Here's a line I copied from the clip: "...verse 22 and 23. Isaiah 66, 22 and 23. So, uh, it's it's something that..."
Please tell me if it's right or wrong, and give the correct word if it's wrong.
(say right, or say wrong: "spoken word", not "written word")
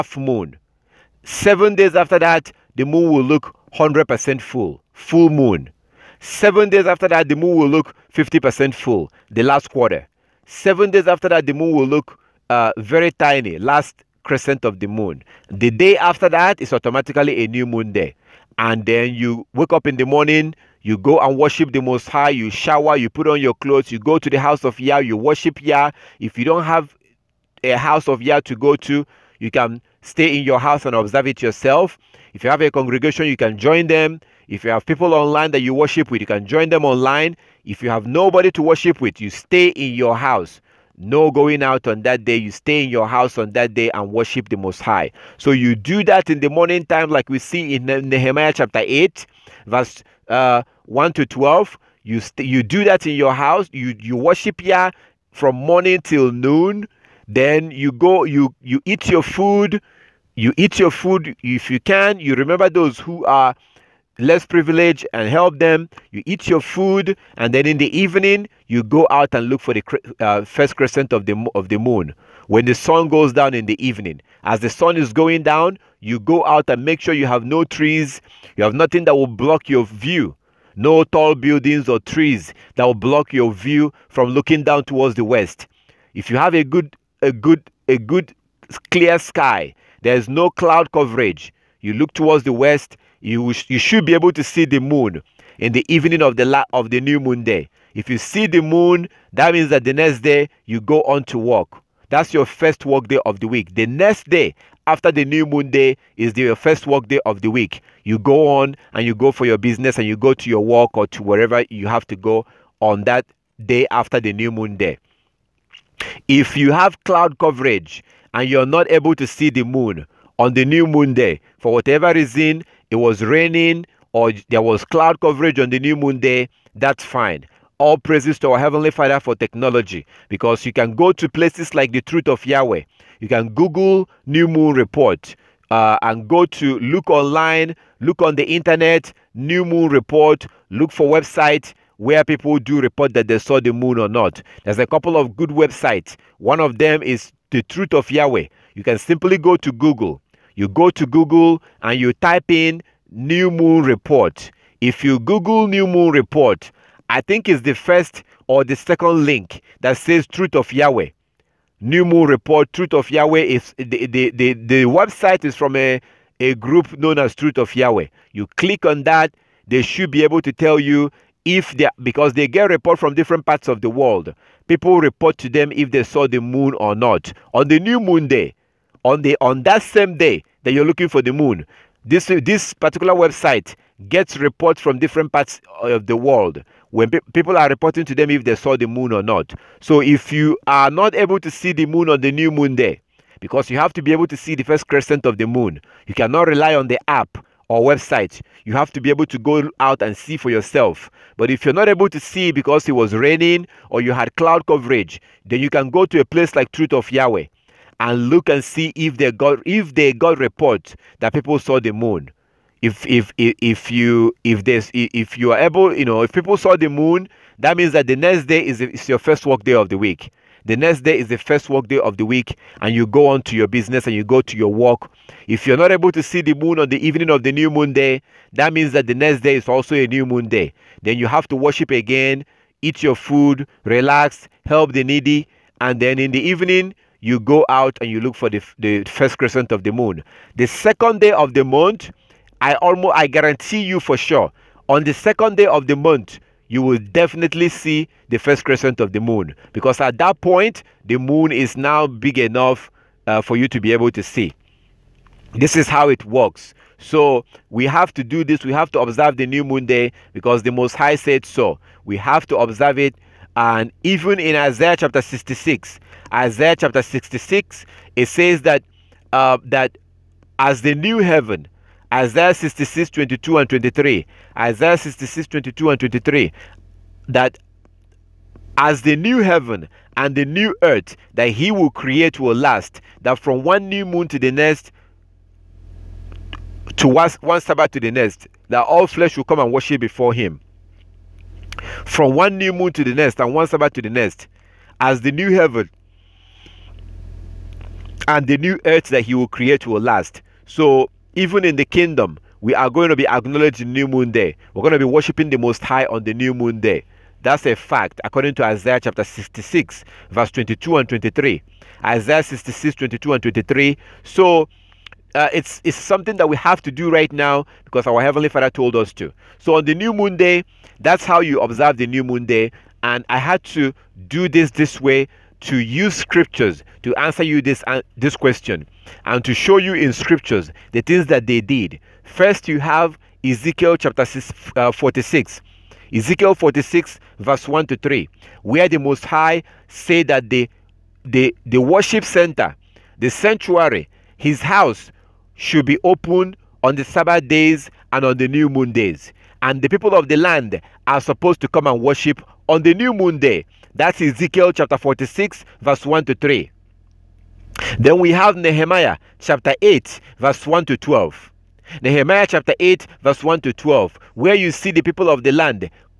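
right.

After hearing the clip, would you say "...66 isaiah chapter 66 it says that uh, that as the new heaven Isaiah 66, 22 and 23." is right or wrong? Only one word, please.
right.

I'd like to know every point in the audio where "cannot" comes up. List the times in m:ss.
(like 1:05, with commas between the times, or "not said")
3:16.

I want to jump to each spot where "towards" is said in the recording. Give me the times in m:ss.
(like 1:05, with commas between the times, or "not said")
1:24, 1:32.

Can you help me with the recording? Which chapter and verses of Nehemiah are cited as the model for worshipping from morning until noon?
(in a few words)
Nehemiah 8:1-12.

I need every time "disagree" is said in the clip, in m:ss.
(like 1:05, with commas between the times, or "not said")
not said.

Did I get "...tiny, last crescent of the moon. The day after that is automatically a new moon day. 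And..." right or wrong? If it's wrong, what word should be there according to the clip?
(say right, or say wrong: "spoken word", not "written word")
right.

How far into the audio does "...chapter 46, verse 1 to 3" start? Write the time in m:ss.
5:54.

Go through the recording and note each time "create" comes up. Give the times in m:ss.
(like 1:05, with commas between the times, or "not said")
4:41, 4:59.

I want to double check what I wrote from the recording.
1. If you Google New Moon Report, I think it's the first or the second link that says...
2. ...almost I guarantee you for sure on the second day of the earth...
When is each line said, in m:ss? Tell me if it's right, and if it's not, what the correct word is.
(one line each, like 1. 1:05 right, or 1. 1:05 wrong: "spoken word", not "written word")
1. 2:34 right
2. 4:02 wrong: "month", not "earth".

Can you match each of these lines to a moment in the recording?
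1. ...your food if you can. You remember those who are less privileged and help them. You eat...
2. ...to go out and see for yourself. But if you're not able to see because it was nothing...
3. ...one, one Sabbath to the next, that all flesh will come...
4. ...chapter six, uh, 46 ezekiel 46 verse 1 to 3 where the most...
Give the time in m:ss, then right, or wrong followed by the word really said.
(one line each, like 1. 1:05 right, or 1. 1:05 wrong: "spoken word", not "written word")
1. 1:00 right
2. 3:19 wrong: "raining", not "nothing"
3. 4:47 right
4. 5:33 right.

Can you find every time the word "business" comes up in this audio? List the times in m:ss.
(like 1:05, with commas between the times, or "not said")
1:49, 3:43.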